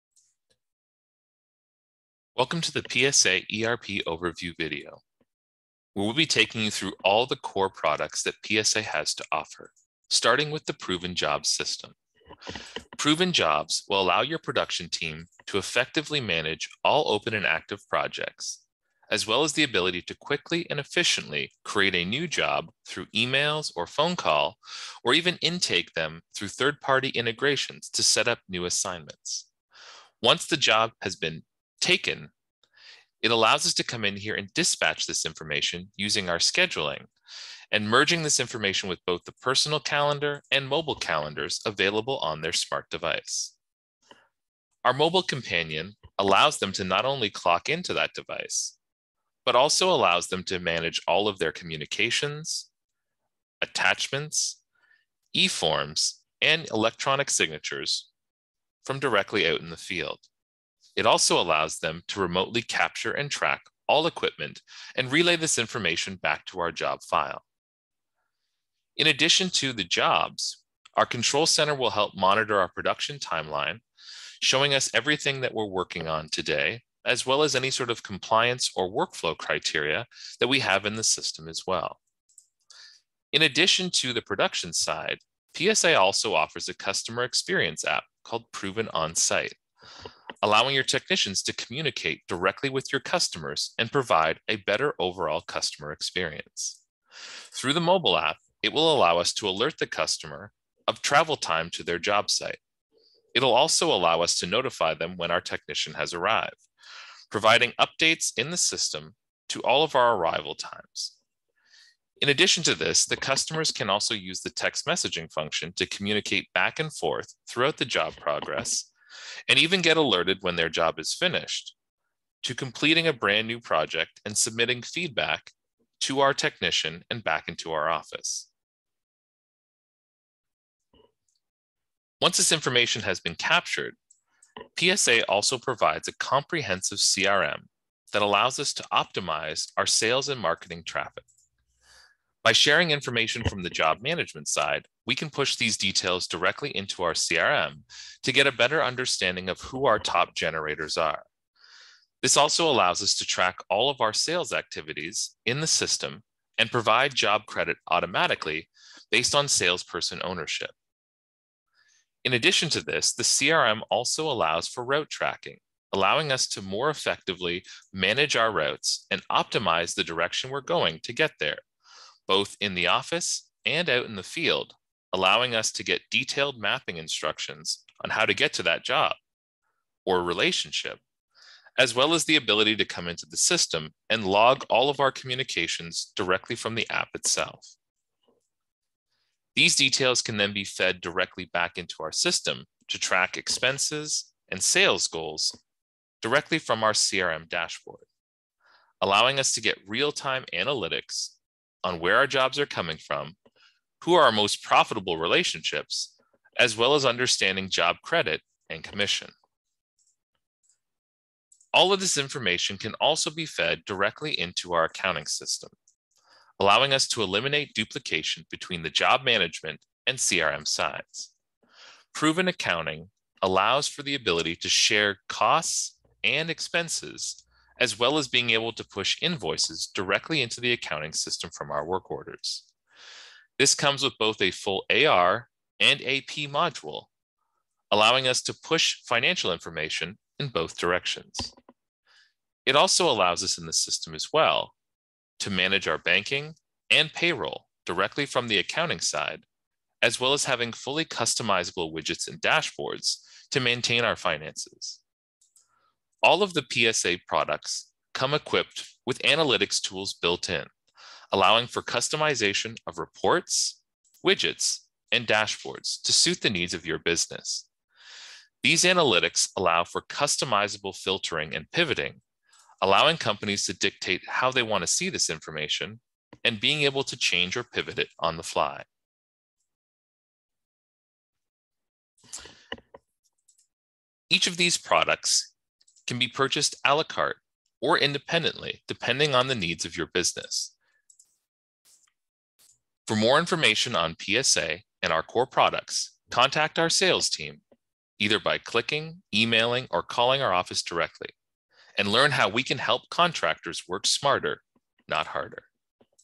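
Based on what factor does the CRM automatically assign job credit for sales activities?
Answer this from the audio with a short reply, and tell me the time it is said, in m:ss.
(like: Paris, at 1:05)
Salesperson ownership, at 2:39.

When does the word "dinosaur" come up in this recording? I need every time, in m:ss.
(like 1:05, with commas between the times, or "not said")
not said.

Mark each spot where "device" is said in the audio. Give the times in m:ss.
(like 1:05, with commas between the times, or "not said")
0:42, 0:48.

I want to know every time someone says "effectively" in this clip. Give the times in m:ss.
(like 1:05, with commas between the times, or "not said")
0:15, 2:46.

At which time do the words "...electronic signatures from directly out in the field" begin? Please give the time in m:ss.
0:56.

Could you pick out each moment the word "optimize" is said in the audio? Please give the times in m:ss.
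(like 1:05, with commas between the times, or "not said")
2:18, 2:49.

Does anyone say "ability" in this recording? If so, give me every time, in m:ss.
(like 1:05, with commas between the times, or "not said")
0:19, 3:02, 3:44.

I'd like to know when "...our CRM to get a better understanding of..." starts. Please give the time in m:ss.
2:27.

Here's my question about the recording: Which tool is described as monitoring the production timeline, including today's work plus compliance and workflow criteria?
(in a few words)
Control center.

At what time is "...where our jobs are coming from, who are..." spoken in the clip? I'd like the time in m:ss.
3:21.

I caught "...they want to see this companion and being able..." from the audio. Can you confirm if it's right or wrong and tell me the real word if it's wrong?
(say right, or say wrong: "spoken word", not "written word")
wrong: "information", not "companion".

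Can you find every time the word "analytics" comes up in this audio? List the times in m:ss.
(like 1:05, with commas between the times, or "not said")
3:20, 4:19, 4:28.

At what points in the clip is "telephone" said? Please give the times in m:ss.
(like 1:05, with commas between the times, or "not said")
not said.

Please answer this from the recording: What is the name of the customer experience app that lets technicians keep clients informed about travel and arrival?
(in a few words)
Proven On Site.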